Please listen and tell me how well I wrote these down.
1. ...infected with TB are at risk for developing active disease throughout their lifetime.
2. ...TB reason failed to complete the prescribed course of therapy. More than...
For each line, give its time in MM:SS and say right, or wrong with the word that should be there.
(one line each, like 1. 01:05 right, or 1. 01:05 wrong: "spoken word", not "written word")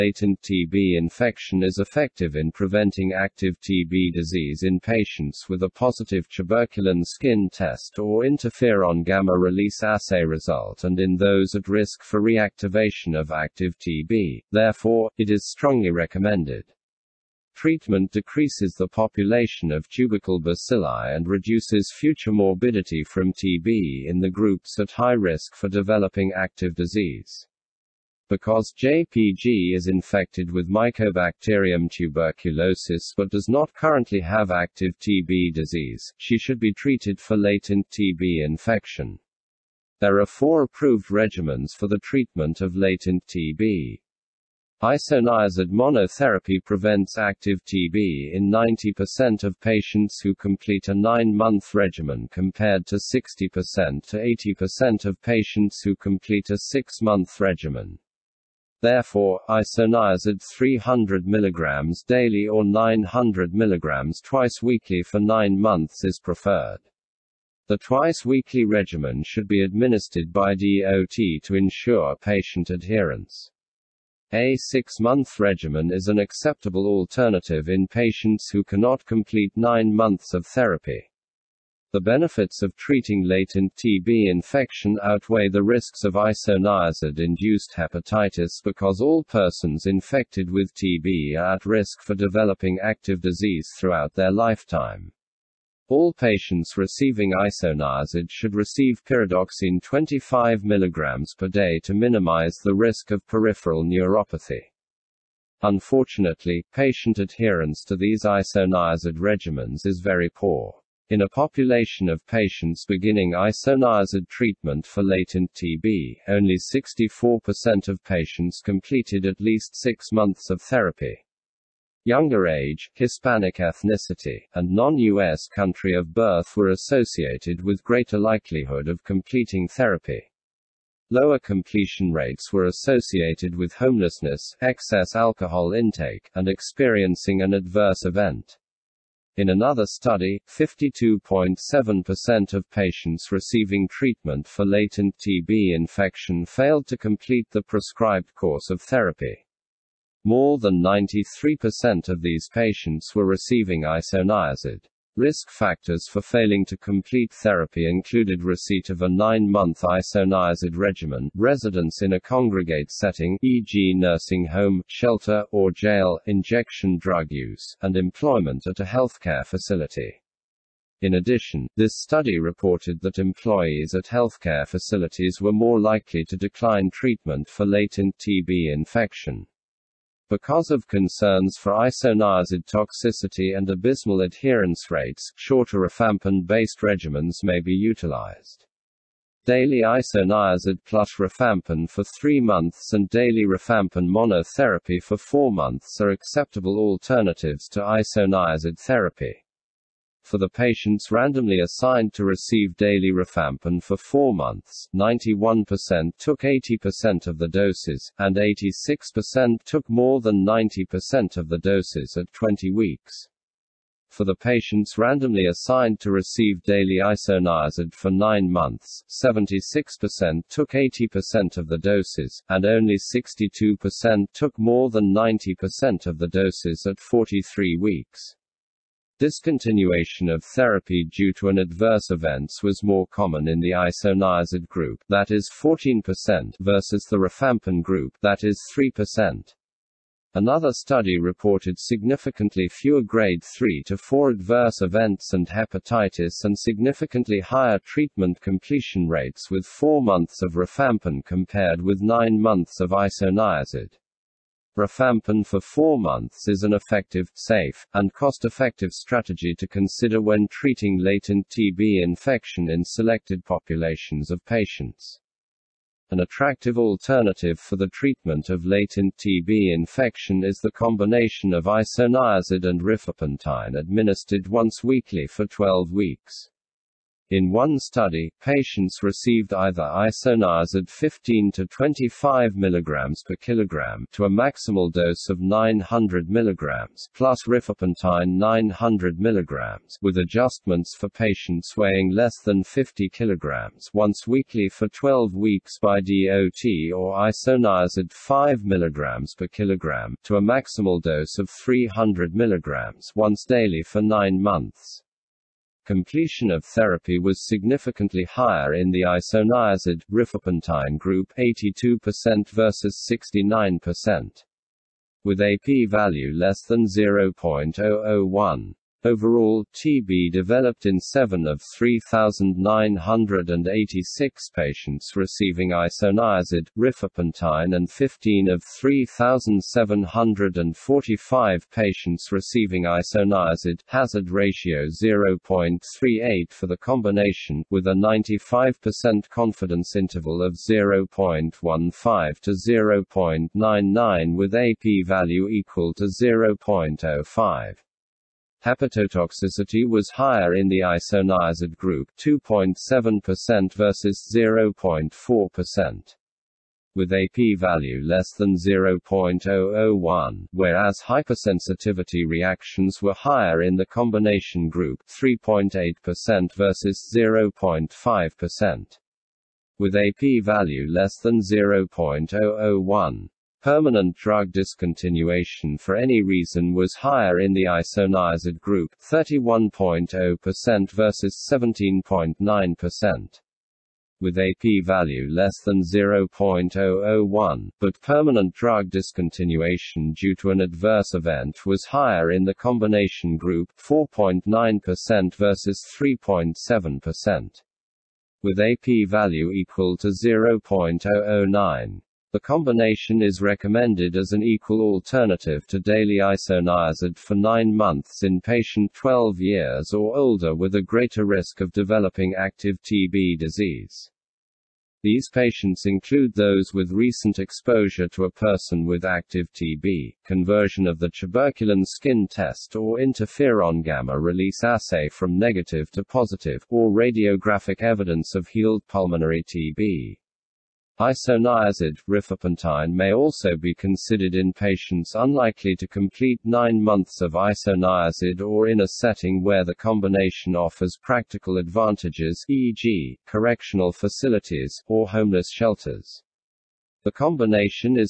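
1. 01:29 right
2. 02:25 wrong: "infection", not "reason".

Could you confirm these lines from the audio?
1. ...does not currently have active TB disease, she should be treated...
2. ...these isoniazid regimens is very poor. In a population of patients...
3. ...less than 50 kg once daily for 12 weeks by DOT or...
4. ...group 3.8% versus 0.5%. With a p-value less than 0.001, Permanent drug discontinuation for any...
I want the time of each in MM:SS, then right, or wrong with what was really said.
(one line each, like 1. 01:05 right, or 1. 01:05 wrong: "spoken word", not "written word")
1. 00:33 right
2. 01:47 right
3. 04:52 wrong: "weekly", not "daily"
4. 06:04 right.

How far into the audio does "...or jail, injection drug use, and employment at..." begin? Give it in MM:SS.
02:45.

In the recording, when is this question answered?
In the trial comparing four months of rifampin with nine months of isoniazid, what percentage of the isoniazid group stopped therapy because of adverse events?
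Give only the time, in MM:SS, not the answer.
03:55.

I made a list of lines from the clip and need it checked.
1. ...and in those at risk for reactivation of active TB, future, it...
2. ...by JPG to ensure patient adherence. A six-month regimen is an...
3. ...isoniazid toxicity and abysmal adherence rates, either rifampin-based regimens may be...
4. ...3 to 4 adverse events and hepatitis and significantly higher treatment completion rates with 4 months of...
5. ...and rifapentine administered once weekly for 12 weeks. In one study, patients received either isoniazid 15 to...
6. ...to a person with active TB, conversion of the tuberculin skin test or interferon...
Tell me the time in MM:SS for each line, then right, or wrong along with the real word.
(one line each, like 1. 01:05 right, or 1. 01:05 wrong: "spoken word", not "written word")
1. 00:10 wrong: "therefore", not "future"
2. 01:10 wrong: "DOT", not "JPG"
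3. 03:01 wrong: "shorter", not "either"
4. 04:03 right
5. 04:32 right
6. 06:58 right.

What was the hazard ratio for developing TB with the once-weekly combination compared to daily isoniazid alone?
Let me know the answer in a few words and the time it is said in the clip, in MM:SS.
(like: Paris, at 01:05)
0.38, at 05:34.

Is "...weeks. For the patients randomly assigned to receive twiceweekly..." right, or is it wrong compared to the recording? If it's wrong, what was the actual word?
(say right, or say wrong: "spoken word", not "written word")
wrong: "daily", not "twiceweekly".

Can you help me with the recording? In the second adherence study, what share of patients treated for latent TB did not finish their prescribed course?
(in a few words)
52.7%.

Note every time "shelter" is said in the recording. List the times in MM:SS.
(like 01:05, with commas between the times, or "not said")
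02:44, 07:25.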